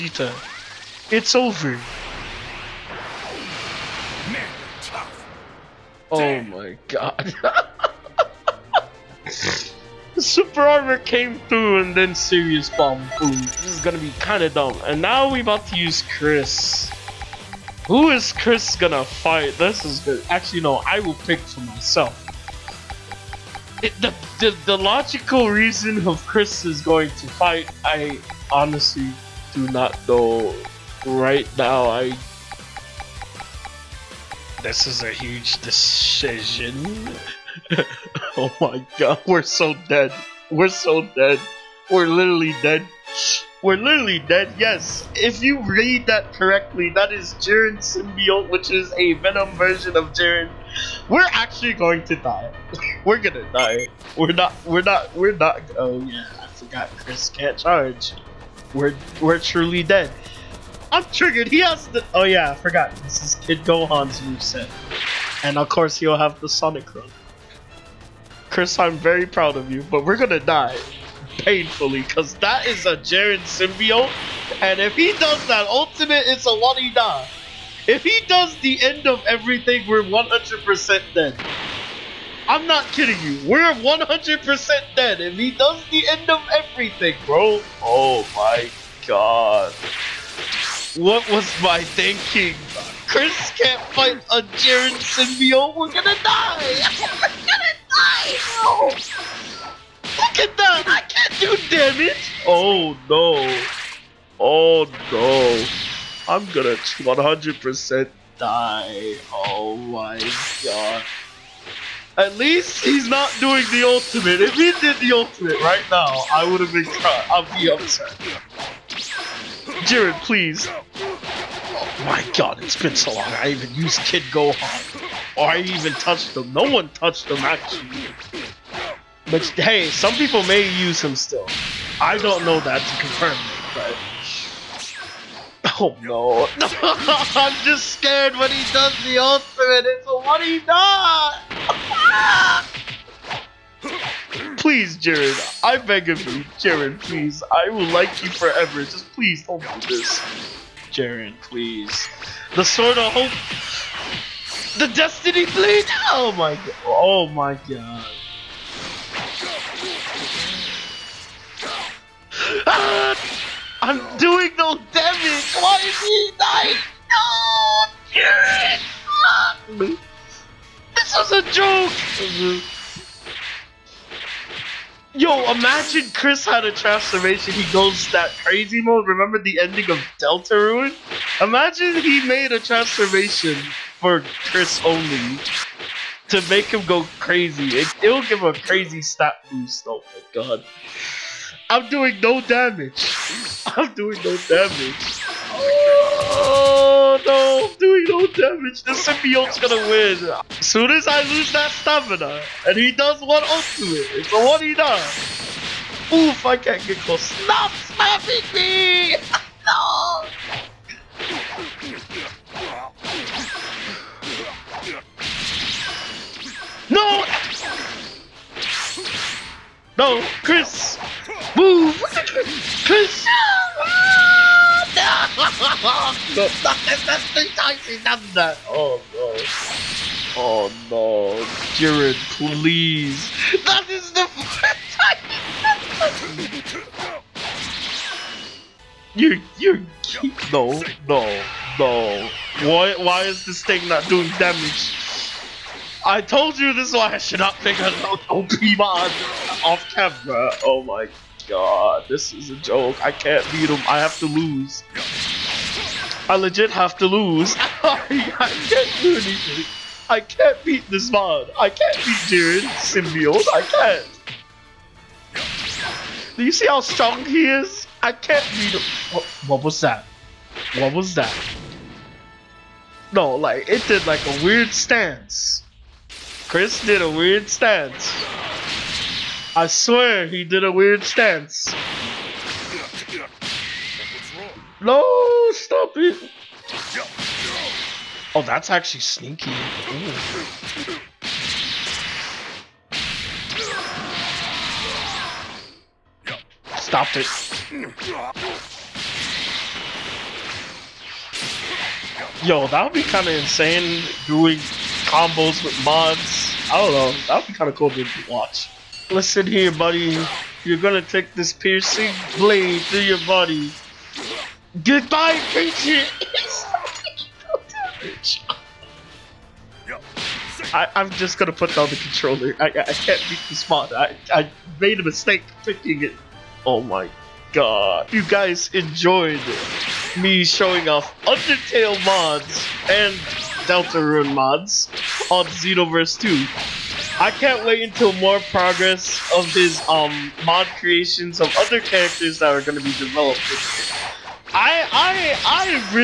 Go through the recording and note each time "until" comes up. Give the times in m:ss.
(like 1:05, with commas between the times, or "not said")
5:37.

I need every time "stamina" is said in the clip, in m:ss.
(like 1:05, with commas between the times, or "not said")
3:21.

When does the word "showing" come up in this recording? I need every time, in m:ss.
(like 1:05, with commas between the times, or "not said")
5:30.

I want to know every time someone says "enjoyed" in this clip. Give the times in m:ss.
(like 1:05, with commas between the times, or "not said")
5:28.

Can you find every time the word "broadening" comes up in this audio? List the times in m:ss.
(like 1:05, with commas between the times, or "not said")
not said.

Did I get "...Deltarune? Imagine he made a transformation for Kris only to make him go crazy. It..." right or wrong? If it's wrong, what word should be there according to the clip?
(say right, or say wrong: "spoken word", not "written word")
right.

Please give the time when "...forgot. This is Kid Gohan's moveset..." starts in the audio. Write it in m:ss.
1:02.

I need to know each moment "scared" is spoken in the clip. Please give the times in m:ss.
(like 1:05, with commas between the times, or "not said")
2:17.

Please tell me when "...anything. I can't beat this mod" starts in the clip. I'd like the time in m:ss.
4:19.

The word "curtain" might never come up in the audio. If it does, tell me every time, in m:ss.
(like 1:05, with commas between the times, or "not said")
not said.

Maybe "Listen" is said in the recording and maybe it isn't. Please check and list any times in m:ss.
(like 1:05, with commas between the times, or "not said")
5:09.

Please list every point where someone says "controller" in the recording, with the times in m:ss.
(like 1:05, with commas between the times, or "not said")
5:21.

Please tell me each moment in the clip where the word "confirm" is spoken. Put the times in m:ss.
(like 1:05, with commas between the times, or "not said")
2:13.